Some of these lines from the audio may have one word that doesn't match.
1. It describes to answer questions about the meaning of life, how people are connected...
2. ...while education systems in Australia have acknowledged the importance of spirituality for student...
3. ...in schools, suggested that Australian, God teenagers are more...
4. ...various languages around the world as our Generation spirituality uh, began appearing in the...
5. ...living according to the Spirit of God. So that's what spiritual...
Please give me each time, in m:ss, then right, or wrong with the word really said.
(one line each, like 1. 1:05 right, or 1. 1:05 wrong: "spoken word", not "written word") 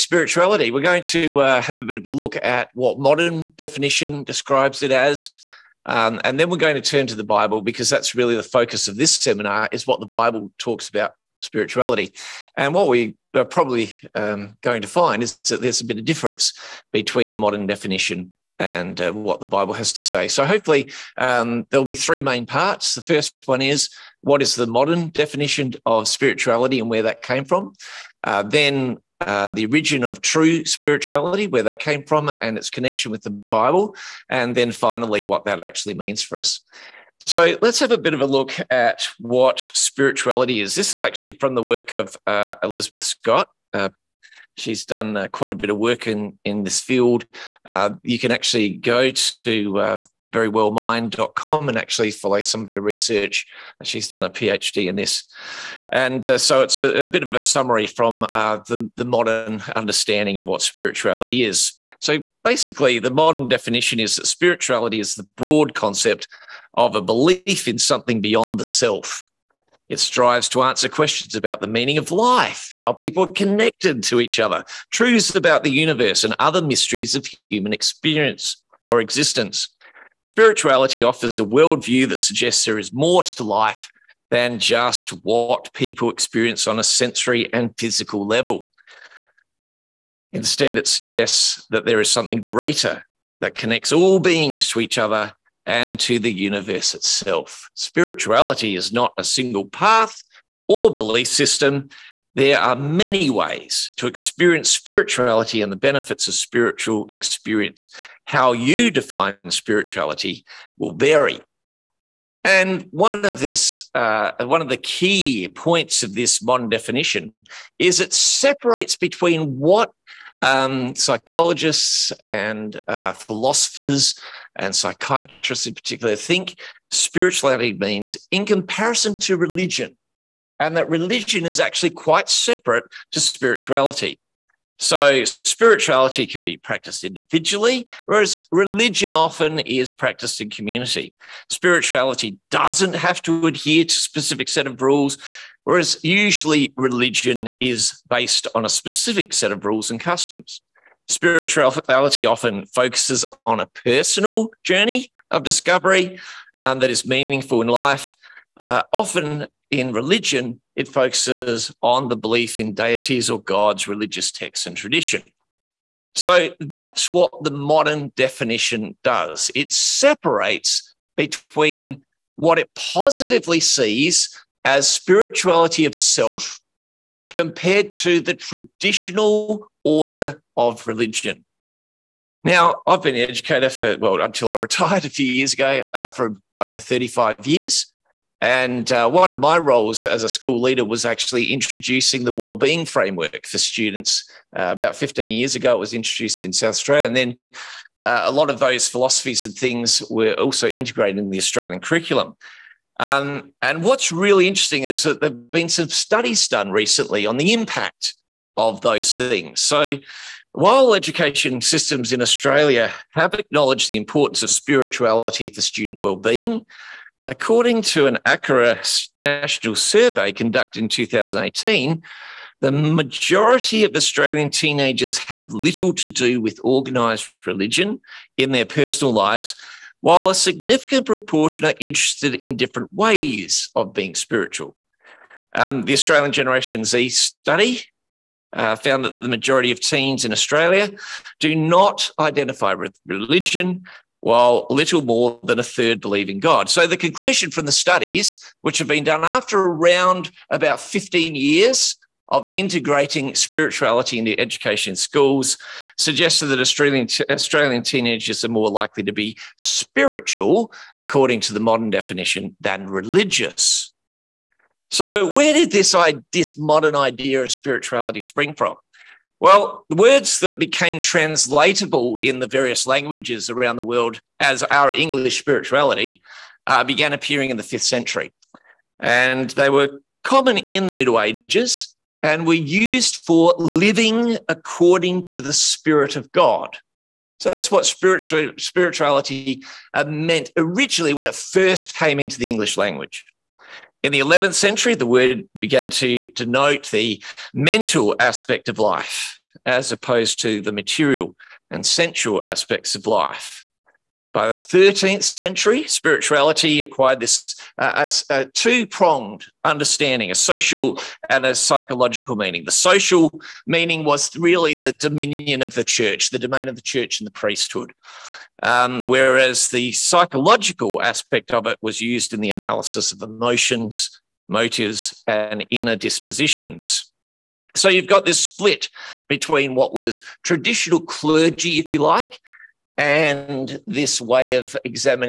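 1. 1:09 wrong: "strives", not "describes"
2. 3:30 right
3. 4:14 wrong: "Australian", not "God"
4. 4:32 wrong: "English", not "Generation"
5. 4:43 right.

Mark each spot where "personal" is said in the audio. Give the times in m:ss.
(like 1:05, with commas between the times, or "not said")
2:33, 3:48.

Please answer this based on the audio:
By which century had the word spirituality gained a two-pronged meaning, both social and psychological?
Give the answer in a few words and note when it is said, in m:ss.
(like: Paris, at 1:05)
13th century, at 5:04.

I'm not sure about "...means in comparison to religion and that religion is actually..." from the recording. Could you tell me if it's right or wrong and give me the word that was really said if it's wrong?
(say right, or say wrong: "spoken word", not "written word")
right.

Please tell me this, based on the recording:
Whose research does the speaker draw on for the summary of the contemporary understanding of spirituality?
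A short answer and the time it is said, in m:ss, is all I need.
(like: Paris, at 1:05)
Elizabeth Scott, at 0:42.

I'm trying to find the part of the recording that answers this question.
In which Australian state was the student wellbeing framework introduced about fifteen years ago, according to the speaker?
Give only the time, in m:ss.
3:16.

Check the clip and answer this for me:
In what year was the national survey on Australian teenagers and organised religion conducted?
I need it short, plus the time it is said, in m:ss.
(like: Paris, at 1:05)
2018, at 3:40.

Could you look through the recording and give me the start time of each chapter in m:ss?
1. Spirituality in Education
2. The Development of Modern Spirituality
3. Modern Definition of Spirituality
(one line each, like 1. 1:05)
1. 3:01
2. 4:24
3. 0:36.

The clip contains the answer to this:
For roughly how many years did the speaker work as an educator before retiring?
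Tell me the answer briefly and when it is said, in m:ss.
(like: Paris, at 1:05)
over 35 years, at 3:06.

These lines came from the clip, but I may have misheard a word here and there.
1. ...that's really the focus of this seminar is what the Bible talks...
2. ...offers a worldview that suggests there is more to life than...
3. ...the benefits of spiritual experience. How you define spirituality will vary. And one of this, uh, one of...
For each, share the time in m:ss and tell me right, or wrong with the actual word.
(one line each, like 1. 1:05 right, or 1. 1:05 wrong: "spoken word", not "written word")
1. 0:07 right
2. 1:21 right
3. 1:45 right.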